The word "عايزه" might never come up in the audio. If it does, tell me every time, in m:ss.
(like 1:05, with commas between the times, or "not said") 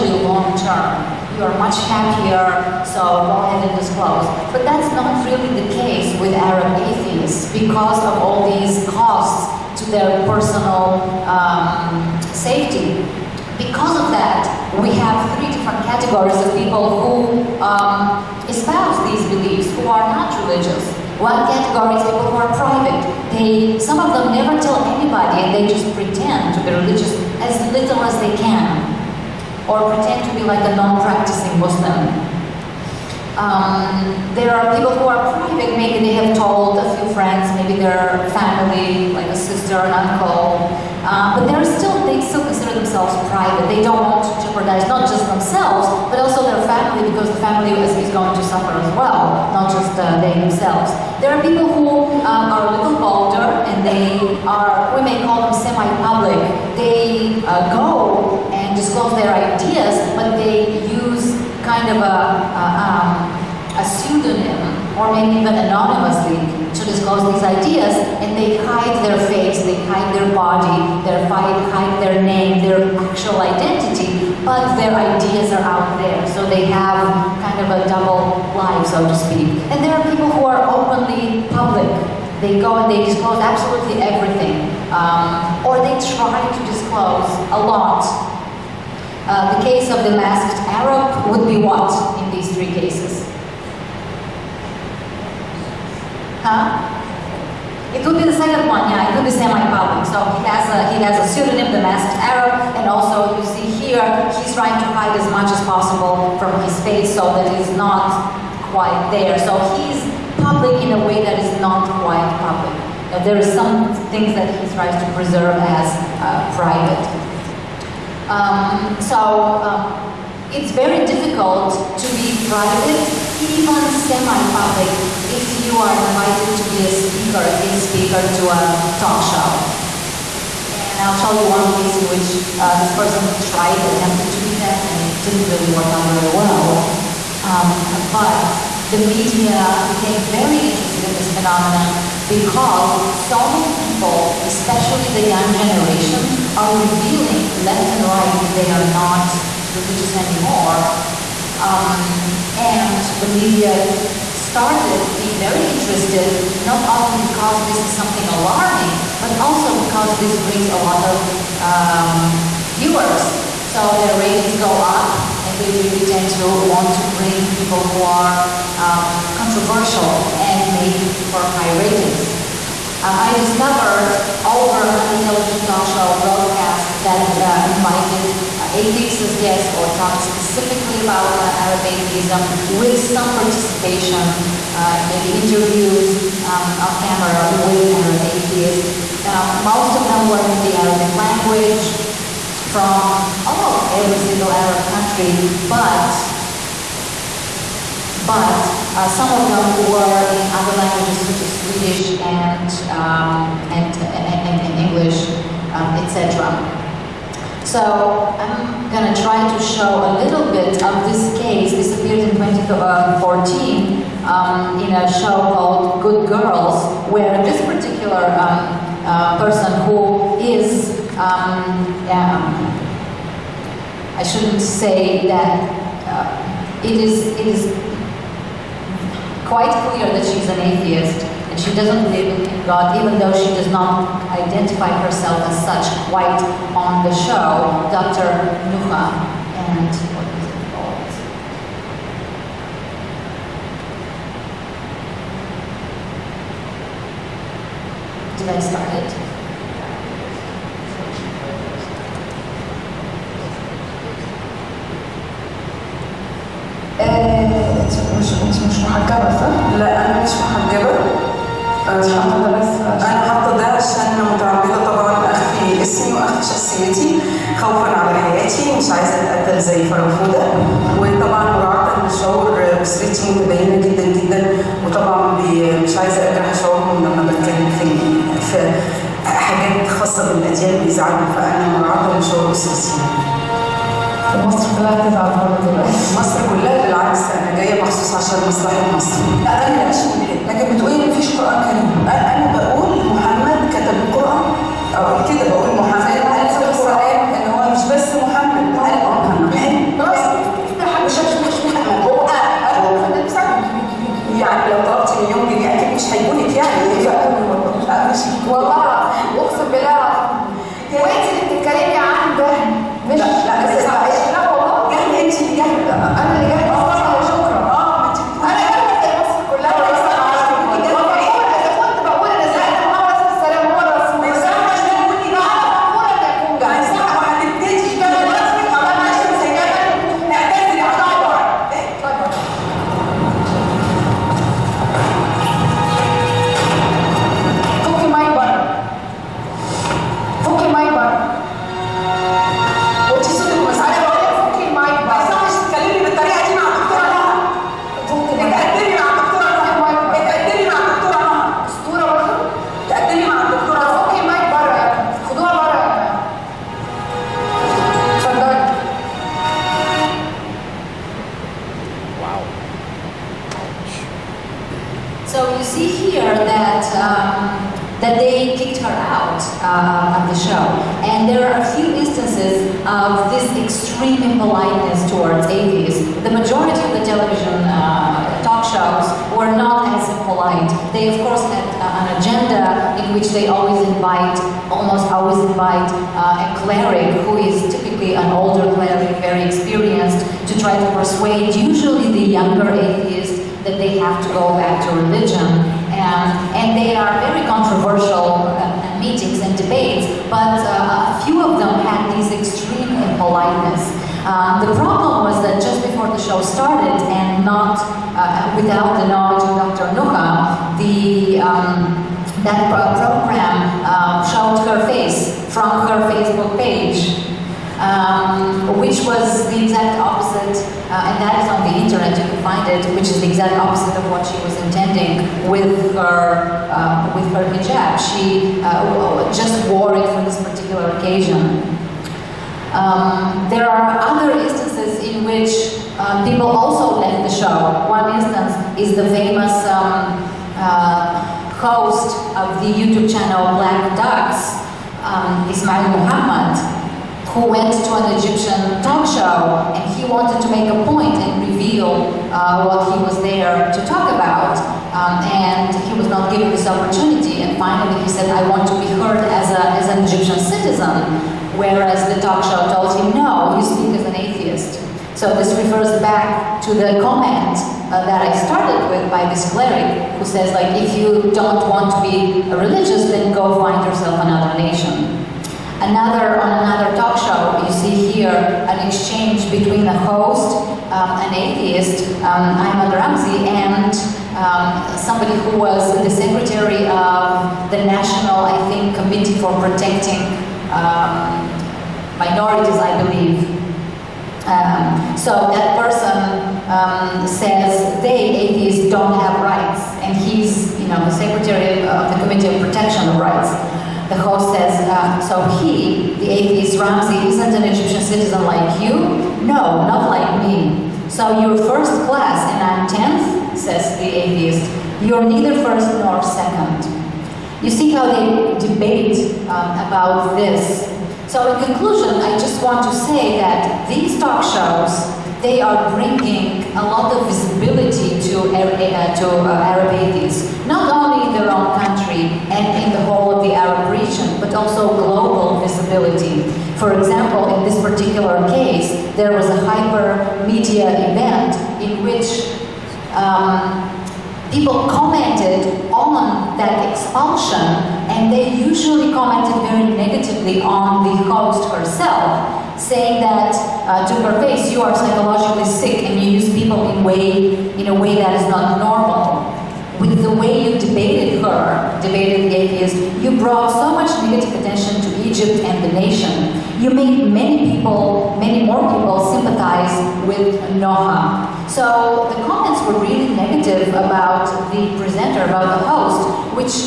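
4:28, 4:35.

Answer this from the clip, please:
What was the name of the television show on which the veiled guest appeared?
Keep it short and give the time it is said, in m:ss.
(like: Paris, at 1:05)
Good Girls, at 3:36.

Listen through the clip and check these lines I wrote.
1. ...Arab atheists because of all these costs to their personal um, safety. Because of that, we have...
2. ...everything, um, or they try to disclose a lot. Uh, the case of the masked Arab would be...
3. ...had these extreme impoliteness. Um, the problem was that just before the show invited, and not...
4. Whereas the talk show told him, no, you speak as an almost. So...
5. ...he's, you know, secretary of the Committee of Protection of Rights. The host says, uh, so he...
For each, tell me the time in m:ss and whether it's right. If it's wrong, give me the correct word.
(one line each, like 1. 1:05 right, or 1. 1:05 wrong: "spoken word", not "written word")
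1. 0:06 right
2. 1:24 right
3. 6:41 wrong: "started", not "invited"
4. 7:41 wrong: "atheist", not "almost"
5. 8:20 right.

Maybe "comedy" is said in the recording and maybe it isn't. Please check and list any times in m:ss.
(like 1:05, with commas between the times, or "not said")
not said.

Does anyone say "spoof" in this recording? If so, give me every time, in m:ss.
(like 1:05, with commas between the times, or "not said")
not said.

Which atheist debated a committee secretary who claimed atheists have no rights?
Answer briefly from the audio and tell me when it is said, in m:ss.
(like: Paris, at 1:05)
Ayman Ramzi, at 8:02.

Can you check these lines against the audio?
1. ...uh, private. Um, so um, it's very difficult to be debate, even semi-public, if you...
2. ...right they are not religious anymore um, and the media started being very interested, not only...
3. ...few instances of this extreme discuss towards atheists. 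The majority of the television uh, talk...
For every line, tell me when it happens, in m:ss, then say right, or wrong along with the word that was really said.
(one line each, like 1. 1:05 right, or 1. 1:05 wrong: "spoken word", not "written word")
1. 1:56 wrong: "private", not "debate"
2. 2:28 right
3. 6:11 wrong: "impoliteness", not "discuss".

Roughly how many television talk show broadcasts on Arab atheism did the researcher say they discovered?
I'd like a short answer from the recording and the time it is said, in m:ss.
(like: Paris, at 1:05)
over 100, at 2:54.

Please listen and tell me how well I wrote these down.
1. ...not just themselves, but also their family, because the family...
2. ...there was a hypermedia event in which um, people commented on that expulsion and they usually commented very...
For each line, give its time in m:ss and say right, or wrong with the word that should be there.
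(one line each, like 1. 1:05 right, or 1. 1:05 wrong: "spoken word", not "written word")
1. 0:44 right
2. 8:59 right.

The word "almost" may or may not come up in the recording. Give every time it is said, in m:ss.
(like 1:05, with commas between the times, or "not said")
3:13, 6:24.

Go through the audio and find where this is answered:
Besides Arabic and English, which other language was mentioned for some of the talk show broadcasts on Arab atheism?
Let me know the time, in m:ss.
3:21.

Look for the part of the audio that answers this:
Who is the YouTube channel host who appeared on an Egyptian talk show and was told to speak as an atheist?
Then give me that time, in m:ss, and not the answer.
7:25.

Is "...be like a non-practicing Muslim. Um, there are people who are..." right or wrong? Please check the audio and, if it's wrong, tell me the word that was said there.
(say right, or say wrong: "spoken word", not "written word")
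right.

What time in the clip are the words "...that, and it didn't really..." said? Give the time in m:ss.
2:14.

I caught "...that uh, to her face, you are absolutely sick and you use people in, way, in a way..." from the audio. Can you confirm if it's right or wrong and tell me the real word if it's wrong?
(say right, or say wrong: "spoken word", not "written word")
wrong: "psychologically", not "absolutely".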